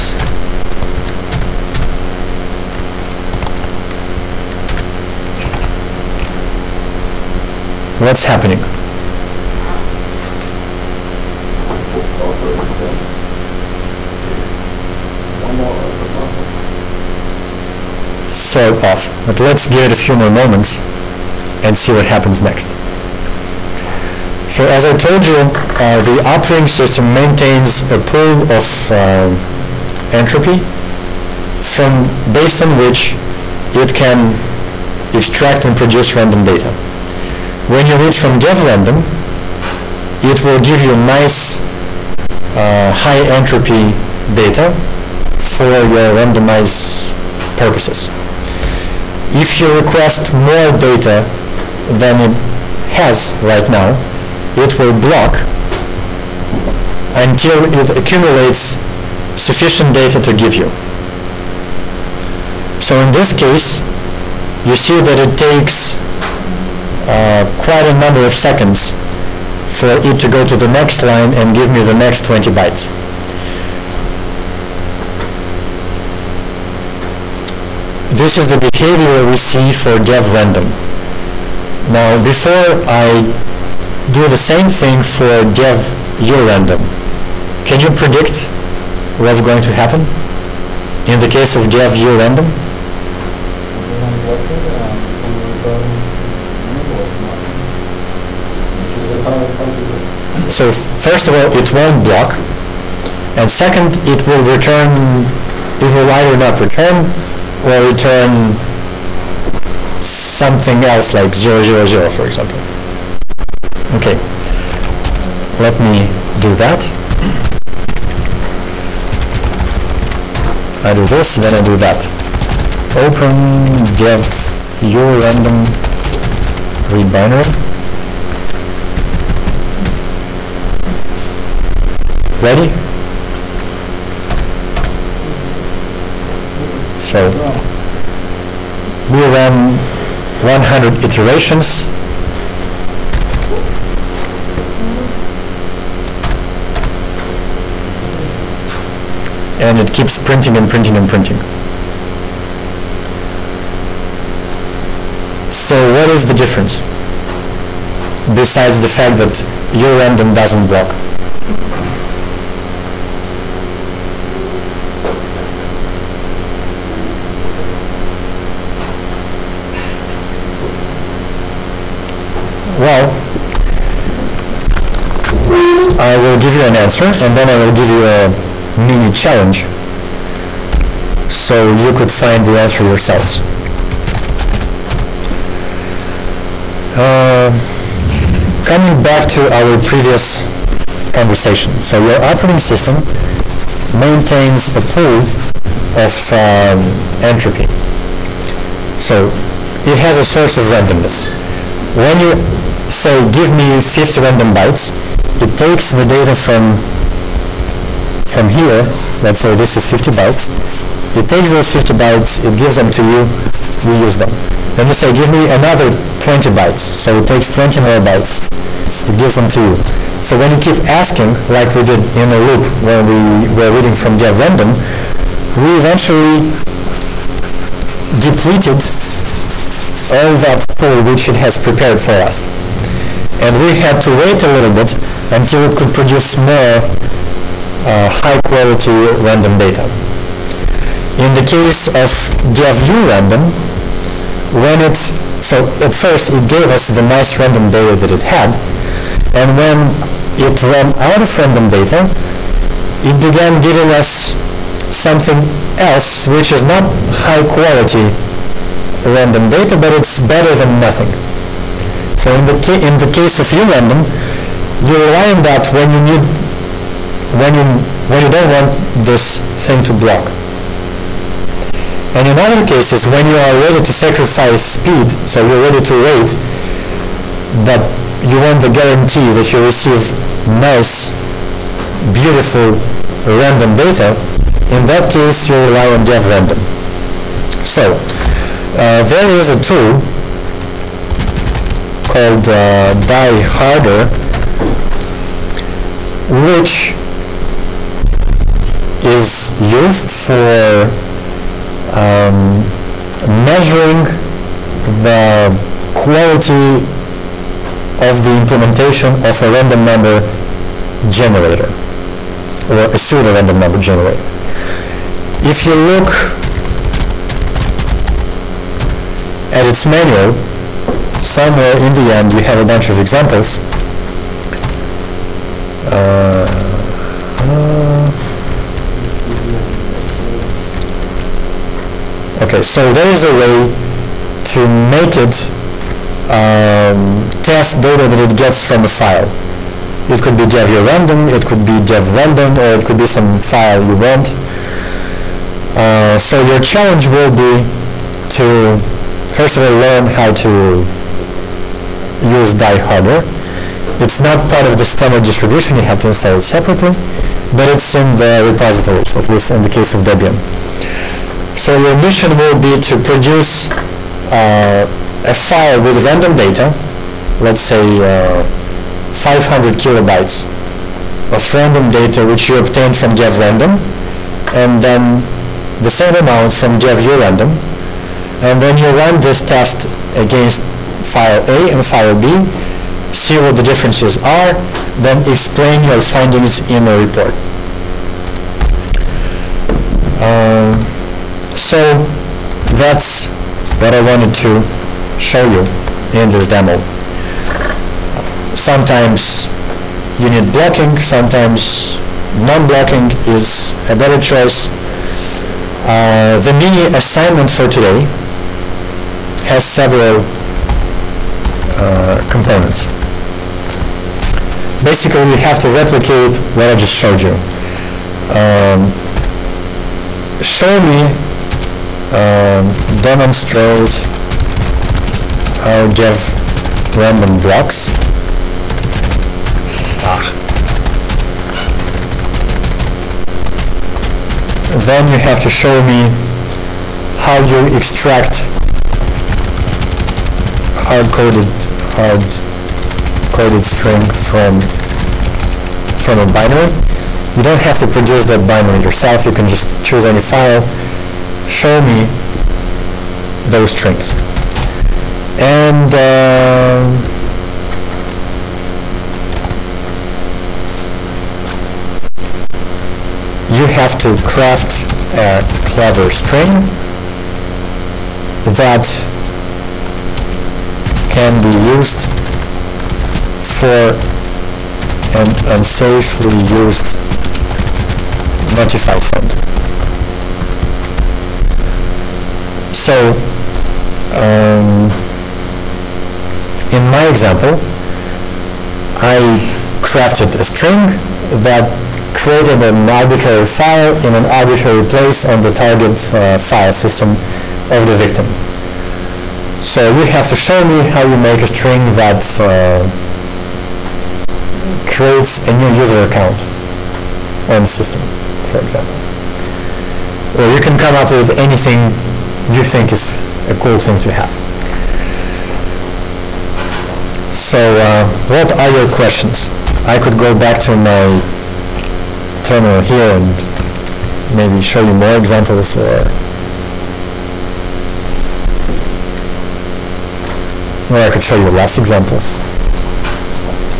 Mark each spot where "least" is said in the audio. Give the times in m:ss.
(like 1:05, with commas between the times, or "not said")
5:59.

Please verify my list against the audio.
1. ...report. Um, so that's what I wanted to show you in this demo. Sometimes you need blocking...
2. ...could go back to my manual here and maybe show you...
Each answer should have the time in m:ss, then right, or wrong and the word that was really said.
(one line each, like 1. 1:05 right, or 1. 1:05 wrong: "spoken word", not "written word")
1. 6:27 right
2. 8:40 wrong: "terminal", not "manual".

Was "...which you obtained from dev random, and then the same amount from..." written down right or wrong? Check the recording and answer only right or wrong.
right.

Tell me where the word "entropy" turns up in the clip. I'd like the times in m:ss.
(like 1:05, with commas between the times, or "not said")
0:30, 0:43, 3:17.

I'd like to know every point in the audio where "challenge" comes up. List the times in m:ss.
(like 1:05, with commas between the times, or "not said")
2:59, 5:46.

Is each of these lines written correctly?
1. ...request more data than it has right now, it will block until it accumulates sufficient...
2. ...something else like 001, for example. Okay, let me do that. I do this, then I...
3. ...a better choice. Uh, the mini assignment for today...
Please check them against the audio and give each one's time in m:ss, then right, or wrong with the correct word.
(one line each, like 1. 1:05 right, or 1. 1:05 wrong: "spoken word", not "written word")
1. 0:49 right
2. 1:49 wrong: "000", not "001"
3. 6:43 right.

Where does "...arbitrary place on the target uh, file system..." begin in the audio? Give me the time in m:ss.
8:14.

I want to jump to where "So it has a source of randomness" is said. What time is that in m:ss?
3:18.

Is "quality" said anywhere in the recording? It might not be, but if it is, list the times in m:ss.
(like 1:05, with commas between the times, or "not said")
3:58, 4:17, 5:05.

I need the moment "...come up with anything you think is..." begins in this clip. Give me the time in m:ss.
8:30.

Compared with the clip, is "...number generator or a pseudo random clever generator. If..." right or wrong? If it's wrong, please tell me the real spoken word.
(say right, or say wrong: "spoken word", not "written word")
wrong: "number", not "clever".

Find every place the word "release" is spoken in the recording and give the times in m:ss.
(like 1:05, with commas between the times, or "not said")
not said.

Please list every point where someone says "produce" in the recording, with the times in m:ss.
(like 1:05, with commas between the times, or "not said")
0:35, 3:55, 6:03, 7:27.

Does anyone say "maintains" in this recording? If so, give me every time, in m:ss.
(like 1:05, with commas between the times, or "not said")
0:27, 3:14.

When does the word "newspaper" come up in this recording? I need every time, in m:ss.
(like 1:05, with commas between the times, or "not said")
not said.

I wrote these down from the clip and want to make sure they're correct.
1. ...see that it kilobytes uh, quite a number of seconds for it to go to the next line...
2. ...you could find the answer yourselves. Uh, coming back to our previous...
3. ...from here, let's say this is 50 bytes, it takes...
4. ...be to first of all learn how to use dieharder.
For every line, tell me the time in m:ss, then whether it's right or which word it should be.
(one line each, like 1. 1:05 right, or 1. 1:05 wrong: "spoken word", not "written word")
1. 1:04 wrong: "takes", not "kilobytes"
2. 3:01 right
3. 3:28 right
4. 5:47 right.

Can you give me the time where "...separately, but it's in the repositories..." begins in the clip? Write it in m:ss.
5:56.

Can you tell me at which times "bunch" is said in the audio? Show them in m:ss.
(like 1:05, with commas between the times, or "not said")
5:22.